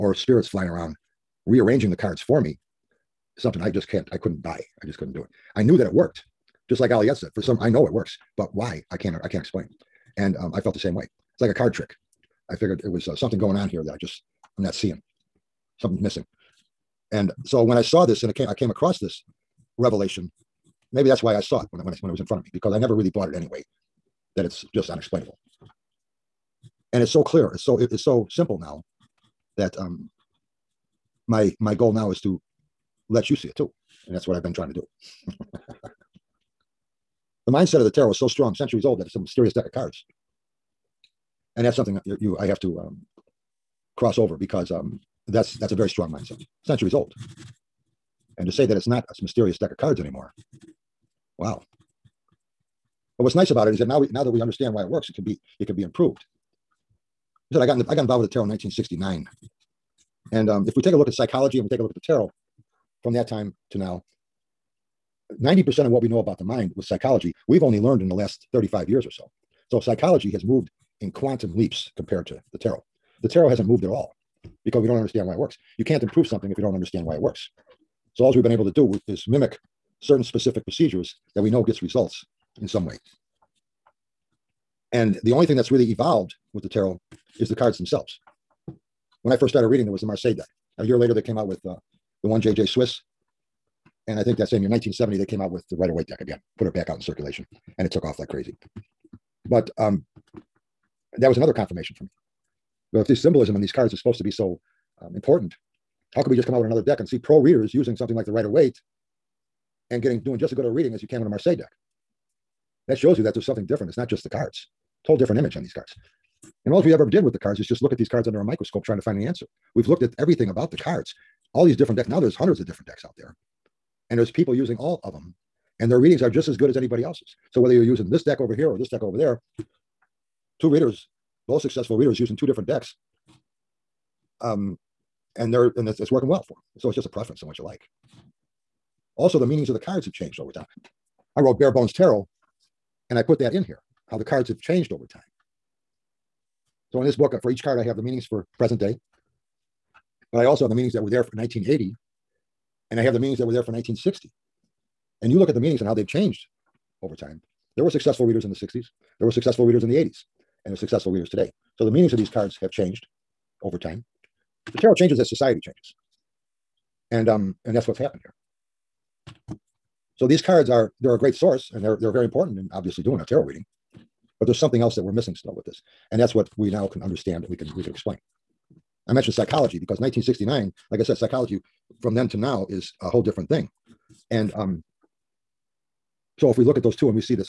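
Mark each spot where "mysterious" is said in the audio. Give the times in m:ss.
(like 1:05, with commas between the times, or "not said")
0:39, 0:49.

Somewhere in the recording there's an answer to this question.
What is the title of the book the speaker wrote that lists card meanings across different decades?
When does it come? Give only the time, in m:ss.
2:21.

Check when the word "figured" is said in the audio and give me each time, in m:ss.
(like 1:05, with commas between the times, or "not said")
0:12.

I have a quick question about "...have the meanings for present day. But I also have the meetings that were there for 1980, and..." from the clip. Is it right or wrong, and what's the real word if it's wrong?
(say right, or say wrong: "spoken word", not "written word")
right.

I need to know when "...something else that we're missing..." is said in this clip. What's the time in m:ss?
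2:54.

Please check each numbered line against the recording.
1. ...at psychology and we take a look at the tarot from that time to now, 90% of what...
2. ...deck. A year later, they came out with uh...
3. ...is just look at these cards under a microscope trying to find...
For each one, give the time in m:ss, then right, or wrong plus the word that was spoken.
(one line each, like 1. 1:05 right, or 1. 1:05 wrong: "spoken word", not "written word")
1. 1:01 right
2. 1:30 right
3. 1:57 right.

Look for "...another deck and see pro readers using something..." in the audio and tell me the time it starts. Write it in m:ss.
1:46.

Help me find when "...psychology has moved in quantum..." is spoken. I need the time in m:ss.
1:09.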